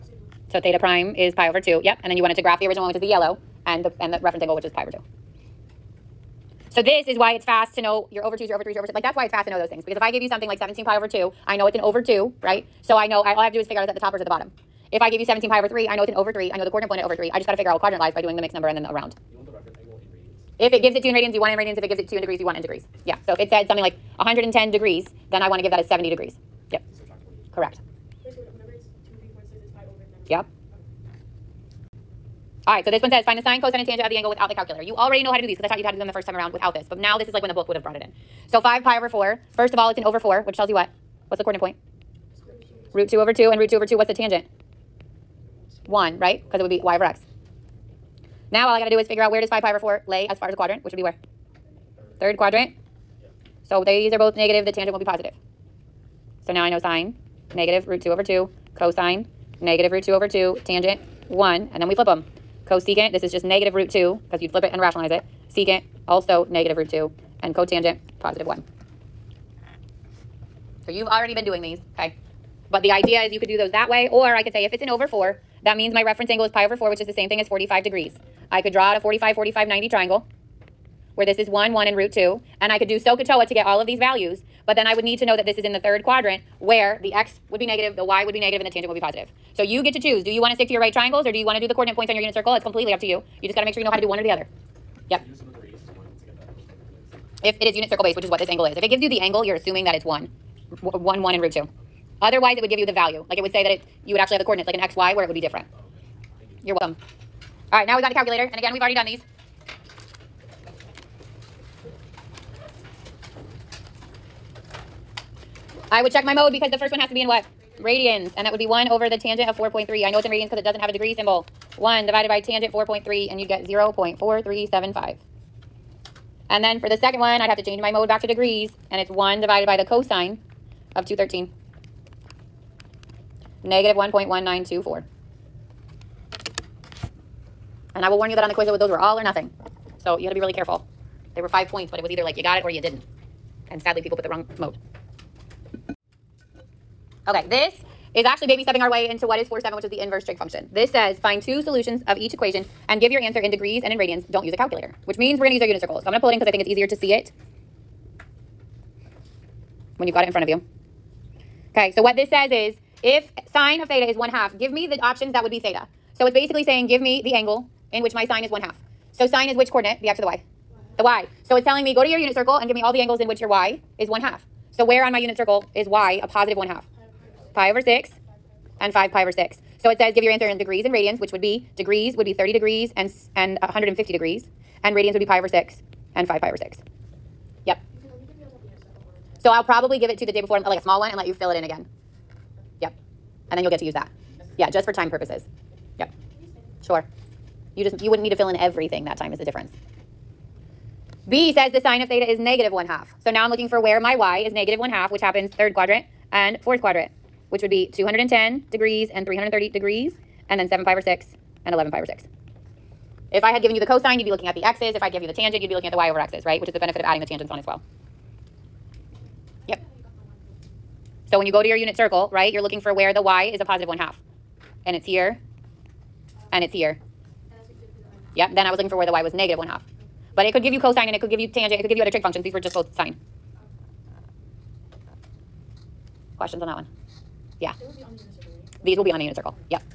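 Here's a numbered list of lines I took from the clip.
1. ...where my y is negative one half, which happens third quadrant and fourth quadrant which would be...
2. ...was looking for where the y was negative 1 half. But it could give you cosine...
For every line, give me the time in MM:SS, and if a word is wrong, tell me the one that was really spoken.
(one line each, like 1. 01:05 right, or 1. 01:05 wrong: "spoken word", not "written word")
1. 03:23 right
2. 03:48 right.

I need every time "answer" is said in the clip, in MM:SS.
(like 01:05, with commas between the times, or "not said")
02:33, 03:00.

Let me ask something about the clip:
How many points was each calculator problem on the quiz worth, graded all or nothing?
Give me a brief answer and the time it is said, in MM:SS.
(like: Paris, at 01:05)
5, at 02:21.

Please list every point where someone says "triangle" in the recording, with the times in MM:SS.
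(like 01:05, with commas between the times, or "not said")
01:19, 01:30.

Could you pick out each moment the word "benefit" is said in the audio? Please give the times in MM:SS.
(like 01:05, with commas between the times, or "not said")
03:36.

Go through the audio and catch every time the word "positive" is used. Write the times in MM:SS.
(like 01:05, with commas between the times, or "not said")
00:55, 01:08, 01:28, 02:56, 03:43.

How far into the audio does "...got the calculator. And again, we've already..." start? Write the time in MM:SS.
01:48.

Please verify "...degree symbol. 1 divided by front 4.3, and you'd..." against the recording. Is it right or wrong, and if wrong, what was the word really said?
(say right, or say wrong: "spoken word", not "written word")
wrong: "tangent", not "front".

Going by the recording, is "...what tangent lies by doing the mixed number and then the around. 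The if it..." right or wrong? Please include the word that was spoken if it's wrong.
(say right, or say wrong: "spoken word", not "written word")
wrong: "quadrant", not "tangent".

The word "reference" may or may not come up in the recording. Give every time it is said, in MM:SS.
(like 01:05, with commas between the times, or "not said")
00:04, 01:16.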